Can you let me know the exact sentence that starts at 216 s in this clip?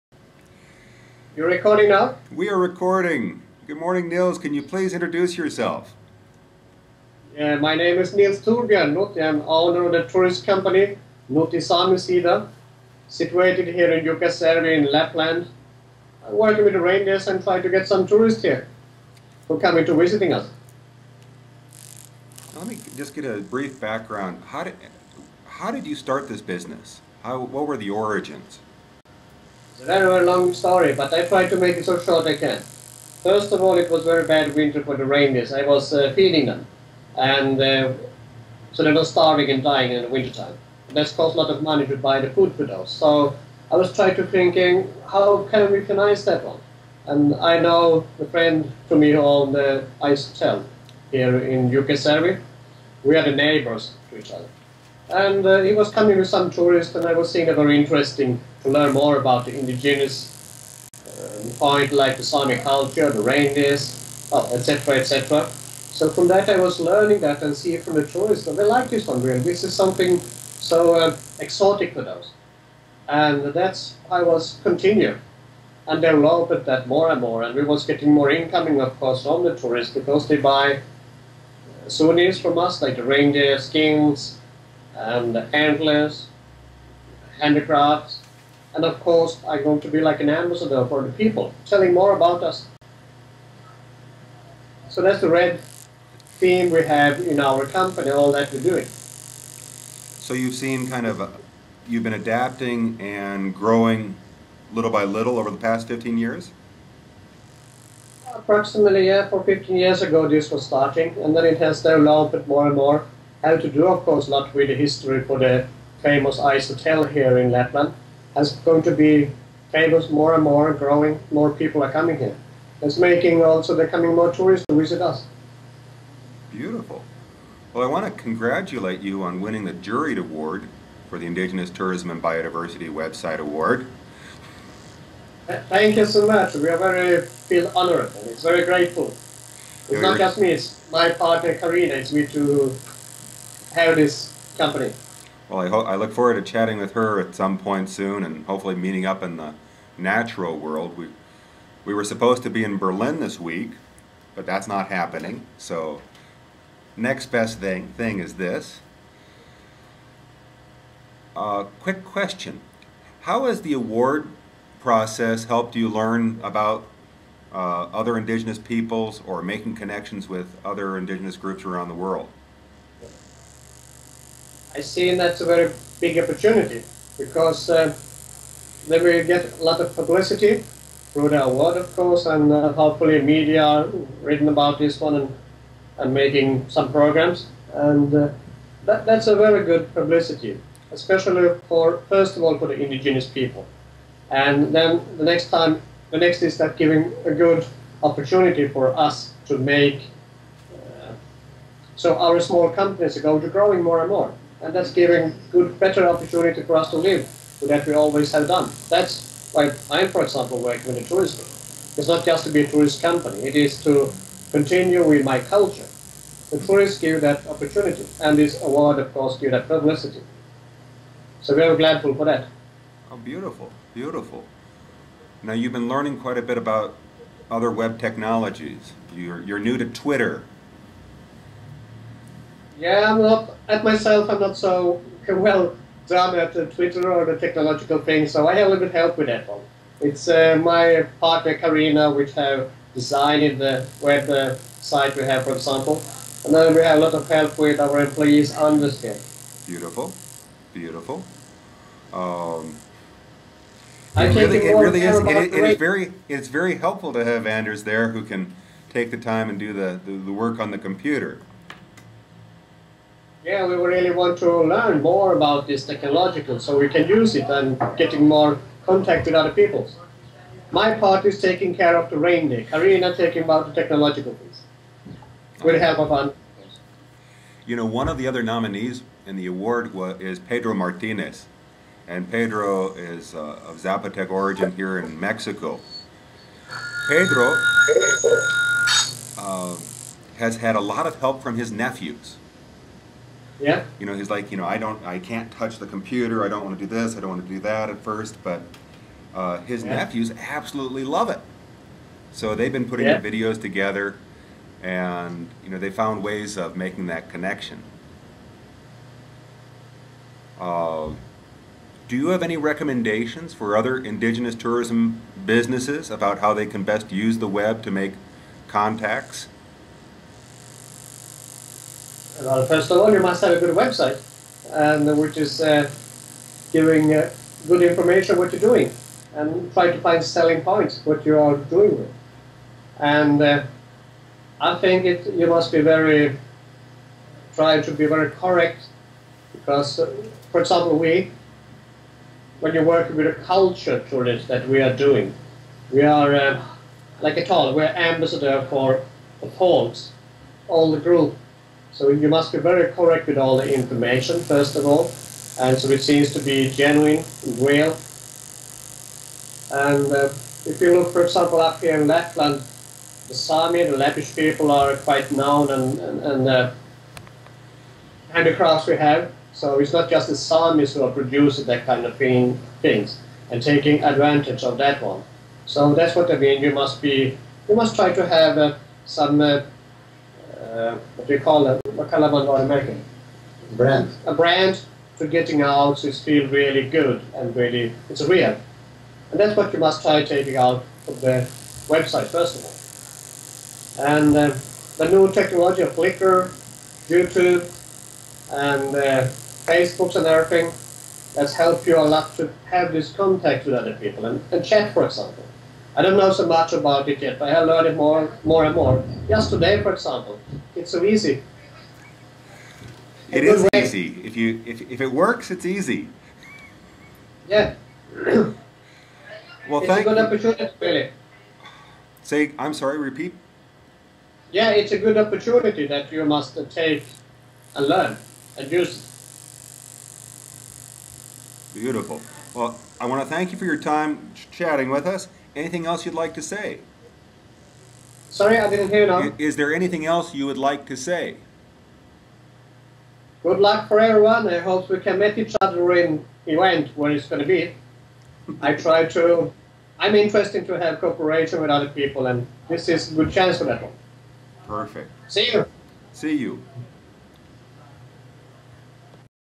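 The tourists give that opportunity, and this award, of course, give that publicity.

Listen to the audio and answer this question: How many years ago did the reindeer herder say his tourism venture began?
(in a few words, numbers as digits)
15.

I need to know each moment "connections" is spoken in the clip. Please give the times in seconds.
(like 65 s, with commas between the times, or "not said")
169 s, 307 s.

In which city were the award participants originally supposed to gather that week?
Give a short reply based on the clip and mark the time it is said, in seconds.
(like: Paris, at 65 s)
Berlin, at 152 s.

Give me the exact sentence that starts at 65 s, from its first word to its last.
So from that, I was learning that and see from the tourists that they like this one really.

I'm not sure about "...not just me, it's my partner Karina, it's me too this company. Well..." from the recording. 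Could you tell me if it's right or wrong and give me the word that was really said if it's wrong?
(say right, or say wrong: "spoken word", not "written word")
right.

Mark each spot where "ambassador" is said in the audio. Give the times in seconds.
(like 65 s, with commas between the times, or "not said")
90 s, 347 s.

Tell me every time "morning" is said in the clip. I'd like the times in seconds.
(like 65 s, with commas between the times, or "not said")
3 s.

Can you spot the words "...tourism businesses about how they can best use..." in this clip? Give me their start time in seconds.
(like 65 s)
314 s.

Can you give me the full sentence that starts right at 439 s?
Is there anything else you would like to say?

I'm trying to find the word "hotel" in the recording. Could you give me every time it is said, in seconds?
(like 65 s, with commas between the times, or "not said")
50 s, 116 s.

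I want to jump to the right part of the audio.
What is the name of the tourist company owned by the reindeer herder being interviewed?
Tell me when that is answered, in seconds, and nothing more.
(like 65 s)
11 s.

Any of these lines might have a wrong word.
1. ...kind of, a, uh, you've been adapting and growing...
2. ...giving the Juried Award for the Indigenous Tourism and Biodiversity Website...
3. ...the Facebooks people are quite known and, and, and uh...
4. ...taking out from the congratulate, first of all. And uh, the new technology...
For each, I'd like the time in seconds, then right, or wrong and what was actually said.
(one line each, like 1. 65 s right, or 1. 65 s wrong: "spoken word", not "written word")
1. 100 s right
2. 129 s wrong: "winning", not "giving"
3. 363 s wrong: "Lappish", not "Facebooks"
4. 390 s wrong: "website", not "congratulate".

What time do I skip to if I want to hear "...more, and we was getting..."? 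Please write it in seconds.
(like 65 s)
77 s.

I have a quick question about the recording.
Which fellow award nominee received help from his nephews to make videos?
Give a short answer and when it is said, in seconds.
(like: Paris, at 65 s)
Pedro Martinez, at 280 s.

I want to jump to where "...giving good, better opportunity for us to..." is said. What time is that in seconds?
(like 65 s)
204 s.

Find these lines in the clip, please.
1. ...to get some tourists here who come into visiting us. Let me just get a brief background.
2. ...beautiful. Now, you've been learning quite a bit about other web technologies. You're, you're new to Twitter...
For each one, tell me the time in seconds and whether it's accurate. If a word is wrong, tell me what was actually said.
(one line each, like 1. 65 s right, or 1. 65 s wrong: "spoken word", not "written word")
1. 17 s right
2. 223 s right.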